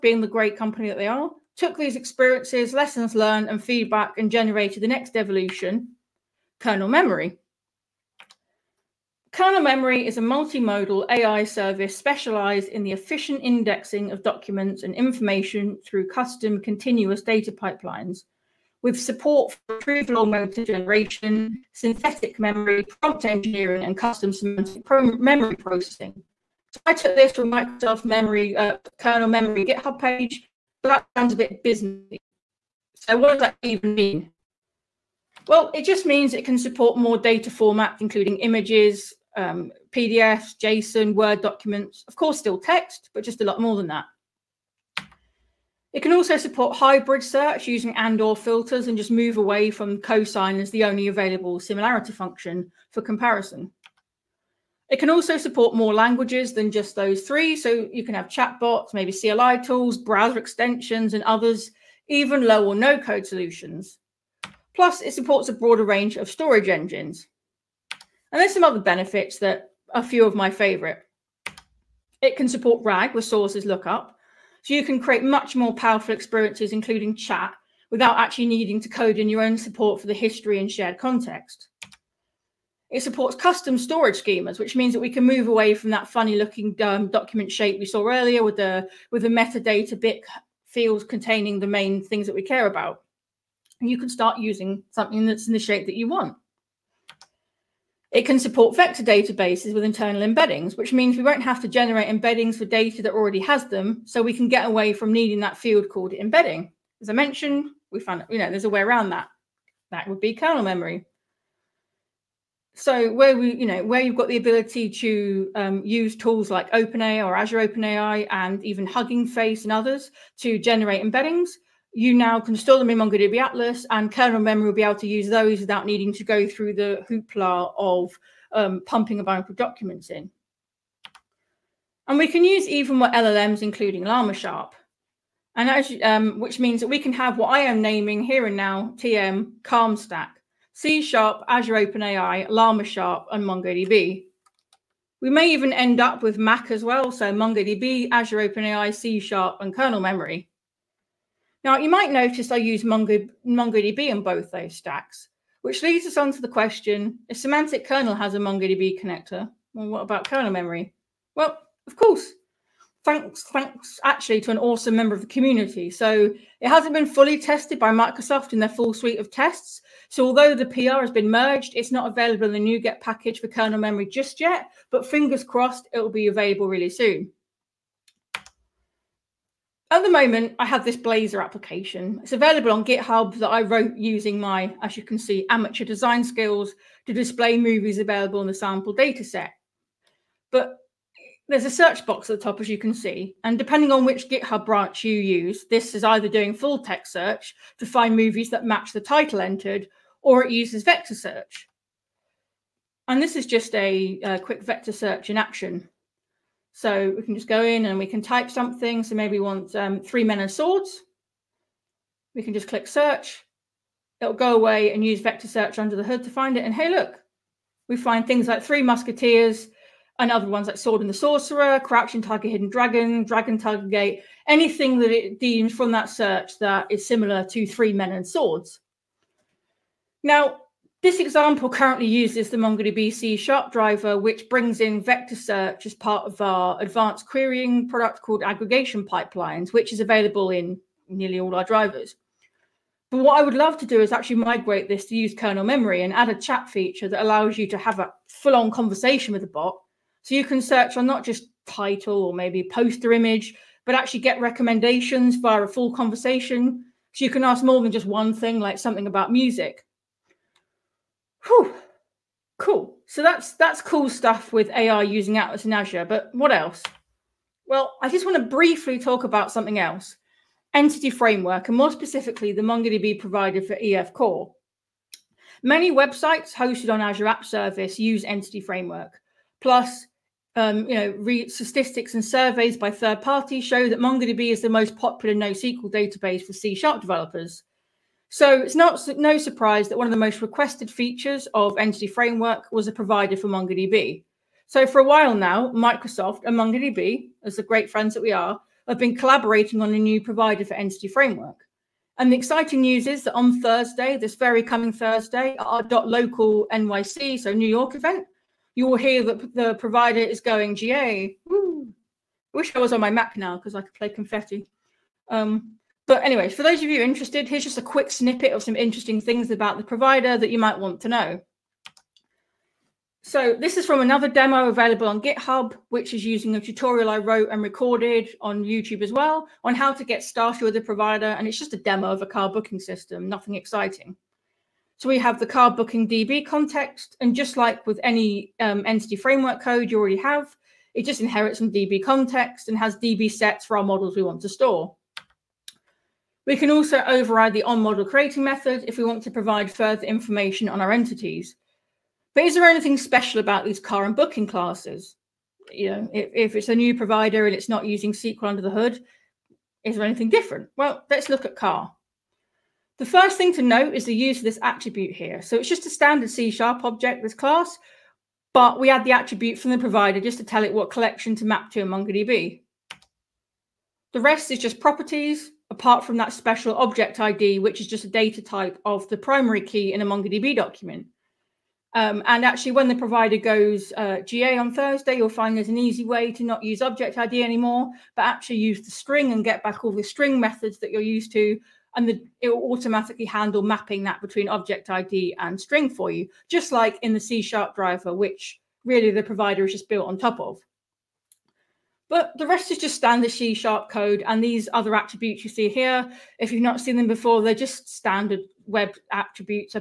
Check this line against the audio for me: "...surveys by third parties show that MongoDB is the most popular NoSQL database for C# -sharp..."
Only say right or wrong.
right.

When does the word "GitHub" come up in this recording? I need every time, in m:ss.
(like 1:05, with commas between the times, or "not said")
0:29, 3:02, 3:14, 5:25.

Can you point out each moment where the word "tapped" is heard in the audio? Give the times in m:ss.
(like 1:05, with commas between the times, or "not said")
not said.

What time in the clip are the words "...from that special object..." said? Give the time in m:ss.
6:16.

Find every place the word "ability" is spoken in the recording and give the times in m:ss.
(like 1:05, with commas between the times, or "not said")
1:54.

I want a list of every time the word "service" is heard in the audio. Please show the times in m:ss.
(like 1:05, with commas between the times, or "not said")
0:11, 4:37.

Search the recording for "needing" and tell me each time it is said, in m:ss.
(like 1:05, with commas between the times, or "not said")
1:18, 1:45, 2:05.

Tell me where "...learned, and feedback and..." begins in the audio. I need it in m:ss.
0:03.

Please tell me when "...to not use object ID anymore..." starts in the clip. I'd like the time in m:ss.
6:26.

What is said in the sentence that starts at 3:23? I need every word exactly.
And this is just a, a quick vector search in action.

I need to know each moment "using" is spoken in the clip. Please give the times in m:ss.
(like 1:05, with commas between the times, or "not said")
0:47, 1:34, 3:03, 4:25, 5:26, 5:57.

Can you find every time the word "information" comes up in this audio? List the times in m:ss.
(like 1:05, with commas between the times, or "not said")
0:14, 5:50.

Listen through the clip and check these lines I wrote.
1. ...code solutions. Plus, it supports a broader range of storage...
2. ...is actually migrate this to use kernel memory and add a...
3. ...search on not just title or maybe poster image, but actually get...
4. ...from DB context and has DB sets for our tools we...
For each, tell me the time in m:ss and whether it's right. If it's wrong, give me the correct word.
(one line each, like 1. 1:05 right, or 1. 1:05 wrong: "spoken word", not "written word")
1. 1:02 right
2. 4:03 right
3. 4:10 right
4. 5:41 wrong: "models", not "tools".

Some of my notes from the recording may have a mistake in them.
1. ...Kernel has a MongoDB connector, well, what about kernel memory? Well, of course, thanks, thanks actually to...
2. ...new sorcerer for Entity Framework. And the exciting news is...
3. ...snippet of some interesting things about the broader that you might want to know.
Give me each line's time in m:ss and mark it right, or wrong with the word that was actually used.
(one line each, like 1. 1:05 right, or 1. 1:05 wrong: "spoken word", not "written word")
1. 2:37 right
2. 4:59 wrong: "provider", not "sorcerer"
3. 5:18 wrong: "provider", not "broader".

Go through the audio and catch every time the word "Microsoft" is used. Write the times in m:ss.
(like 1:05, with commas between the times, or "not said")
0:27, 2:47, 4:55.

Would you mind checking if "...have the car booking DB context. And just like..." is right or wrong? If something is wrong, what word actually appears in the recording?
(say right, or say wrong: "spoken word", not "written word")
right.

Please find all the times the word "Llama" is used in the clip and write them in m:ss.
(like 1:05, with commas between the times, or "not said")
2:14, 2:22.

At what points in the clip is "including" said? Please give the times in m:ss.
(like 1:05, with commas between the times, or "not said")
0:37, 1:16, 2:13.